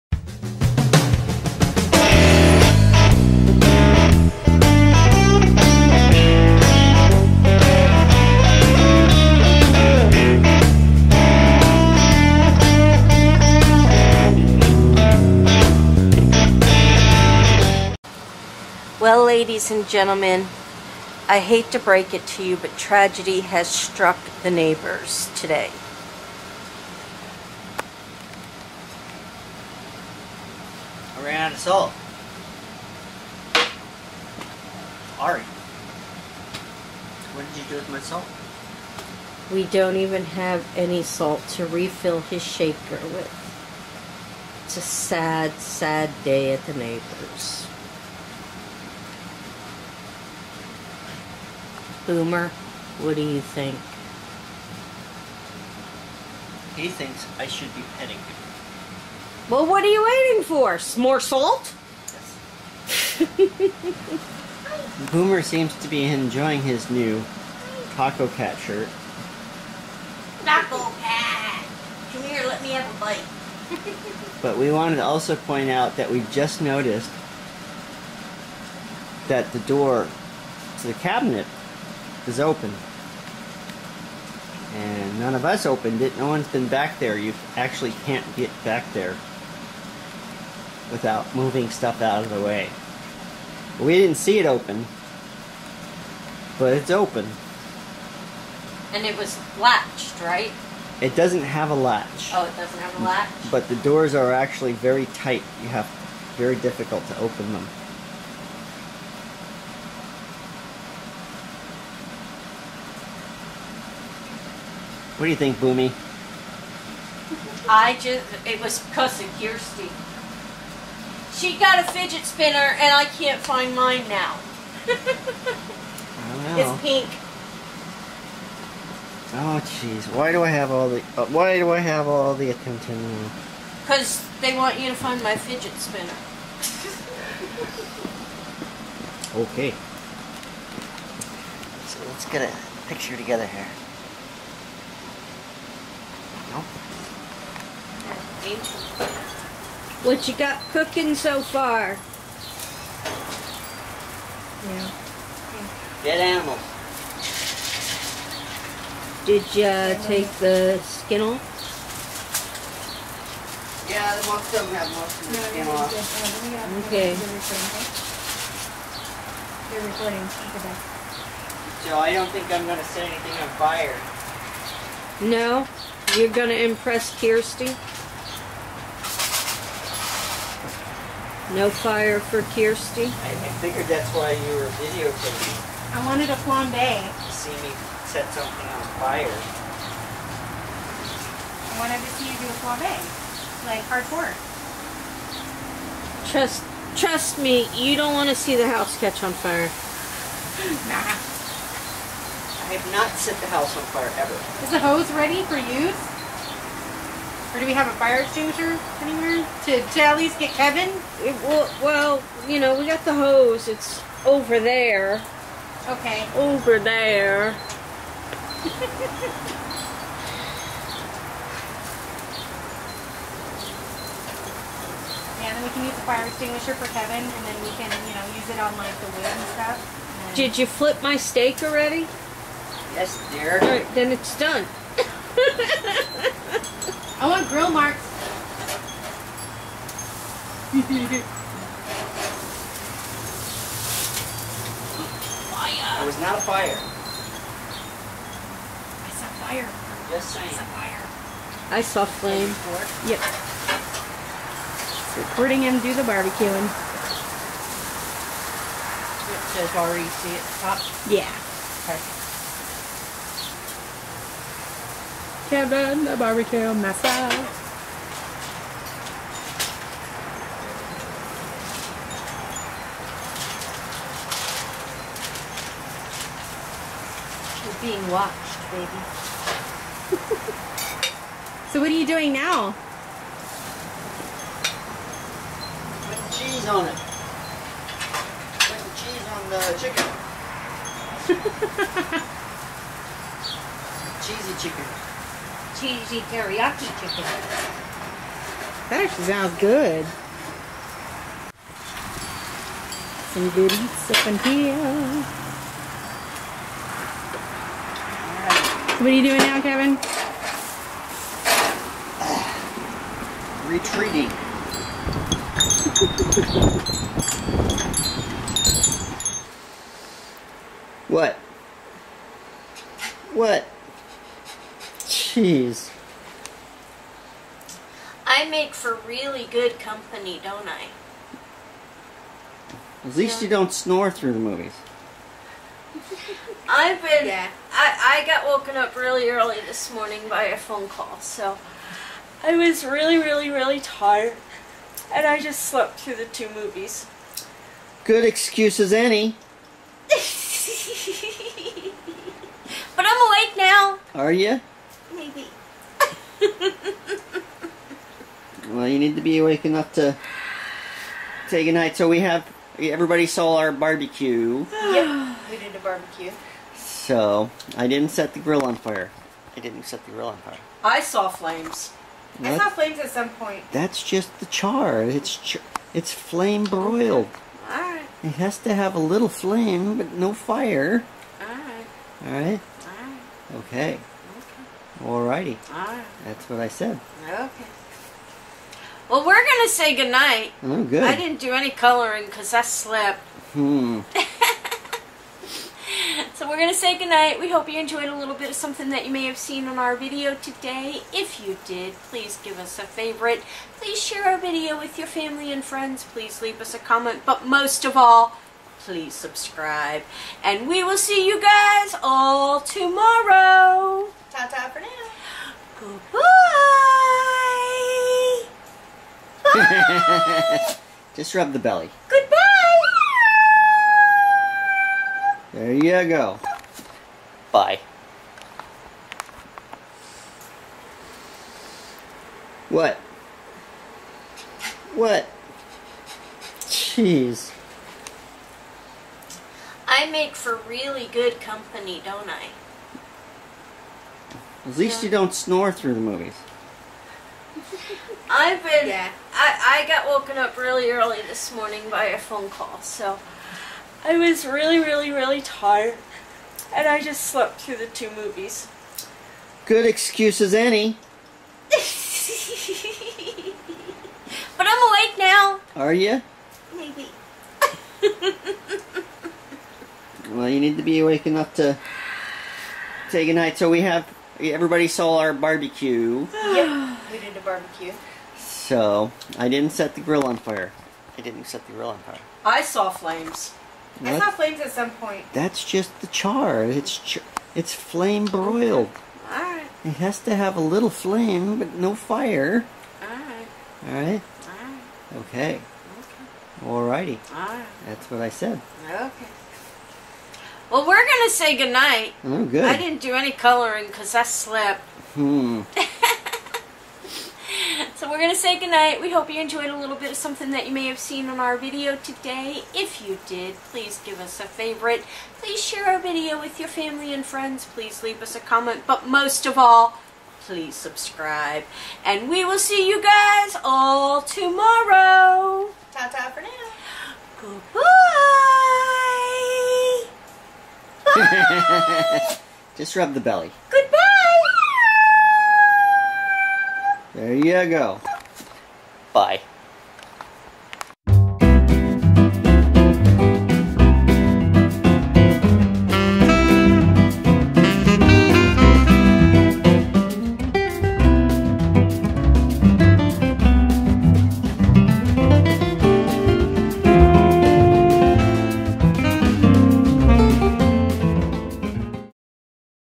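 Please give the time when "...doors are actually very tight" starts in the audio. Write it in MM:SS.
01:43.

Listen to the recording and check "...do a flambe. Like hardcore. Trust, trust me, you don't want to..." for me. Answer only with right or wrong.
right.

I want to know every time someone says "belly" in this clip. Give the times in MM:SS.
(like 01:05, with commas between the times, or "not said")
07:01, 08:53.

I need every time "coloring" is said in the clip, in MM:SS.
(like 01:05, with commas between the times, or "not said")
06:31, 08:23.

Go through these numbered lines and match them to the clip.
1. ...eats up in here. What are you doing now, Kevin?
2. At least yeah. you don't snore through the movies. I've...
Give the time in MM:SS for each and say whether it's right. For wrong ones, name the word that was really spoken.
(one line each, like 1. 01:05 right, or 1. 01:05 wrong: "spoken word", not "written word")
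1. 05:03 right
2. 05:33 right.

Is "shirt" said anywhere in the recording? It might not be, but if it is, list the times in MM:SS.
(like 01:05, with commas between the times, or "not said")
01:08.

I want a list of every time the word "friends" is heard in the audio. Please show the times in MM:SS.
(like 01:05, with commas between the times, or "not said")
06:45, 08:37.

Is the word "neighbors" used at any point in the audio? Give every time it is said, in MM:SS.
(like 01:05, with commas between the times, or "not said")
00:24, 00:46.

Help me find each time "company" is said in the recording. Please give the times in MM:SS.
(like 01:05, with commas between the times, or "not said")
05:29, 07:21.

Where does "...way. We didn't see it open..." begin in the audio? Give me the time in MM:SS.
01:32.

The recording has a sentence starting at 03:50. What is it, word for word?
And Did you flip my steak already?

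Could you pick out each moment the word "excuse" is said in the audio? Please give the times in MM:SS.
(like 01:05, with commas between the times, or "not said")
05:48, 07:39.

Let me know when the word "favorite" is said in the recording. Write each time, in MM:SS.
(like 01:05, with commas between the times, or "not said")
06:42, 08:34.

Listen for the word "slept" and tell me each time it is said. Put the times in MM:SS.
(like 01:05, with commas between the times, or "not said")
05:45, 06:32, 07:37, 08:24.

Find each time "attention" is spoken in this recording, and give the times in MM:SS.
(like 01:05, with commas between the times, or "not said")
02:12.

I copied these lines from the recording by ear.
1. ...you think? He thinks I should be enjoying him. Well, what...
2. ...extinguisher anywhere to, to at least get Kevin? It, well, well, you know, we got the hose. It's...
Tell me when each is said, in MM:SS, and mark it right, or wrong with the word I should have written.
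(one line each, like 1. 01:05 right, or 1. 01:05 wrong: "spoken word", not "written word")
1. 00:53 wrong: "petting", not "enjoying"
2. 03:28 right.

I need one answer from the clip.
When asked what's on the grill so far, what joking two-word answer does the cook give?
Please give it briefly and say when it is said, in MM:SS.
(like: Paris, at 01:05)
Dead animals, at 02:36.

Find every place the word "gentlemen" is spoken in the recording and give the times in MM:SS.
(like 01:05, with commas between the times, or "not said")
00:19.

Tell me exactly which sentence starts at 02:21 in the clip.
So let's get a picture together here.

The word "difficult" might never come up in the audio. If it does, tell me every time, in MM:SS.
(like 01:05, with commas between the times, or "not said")
01:46.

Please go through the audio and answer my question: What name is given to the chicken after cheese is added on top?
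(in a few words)
cheesy teriyaki chicken.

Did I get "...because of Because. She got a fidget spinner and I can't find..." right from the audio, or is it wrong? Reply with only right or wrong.
wrong.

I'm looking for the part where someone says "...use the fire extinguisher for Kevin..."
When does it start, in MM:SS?
03:45.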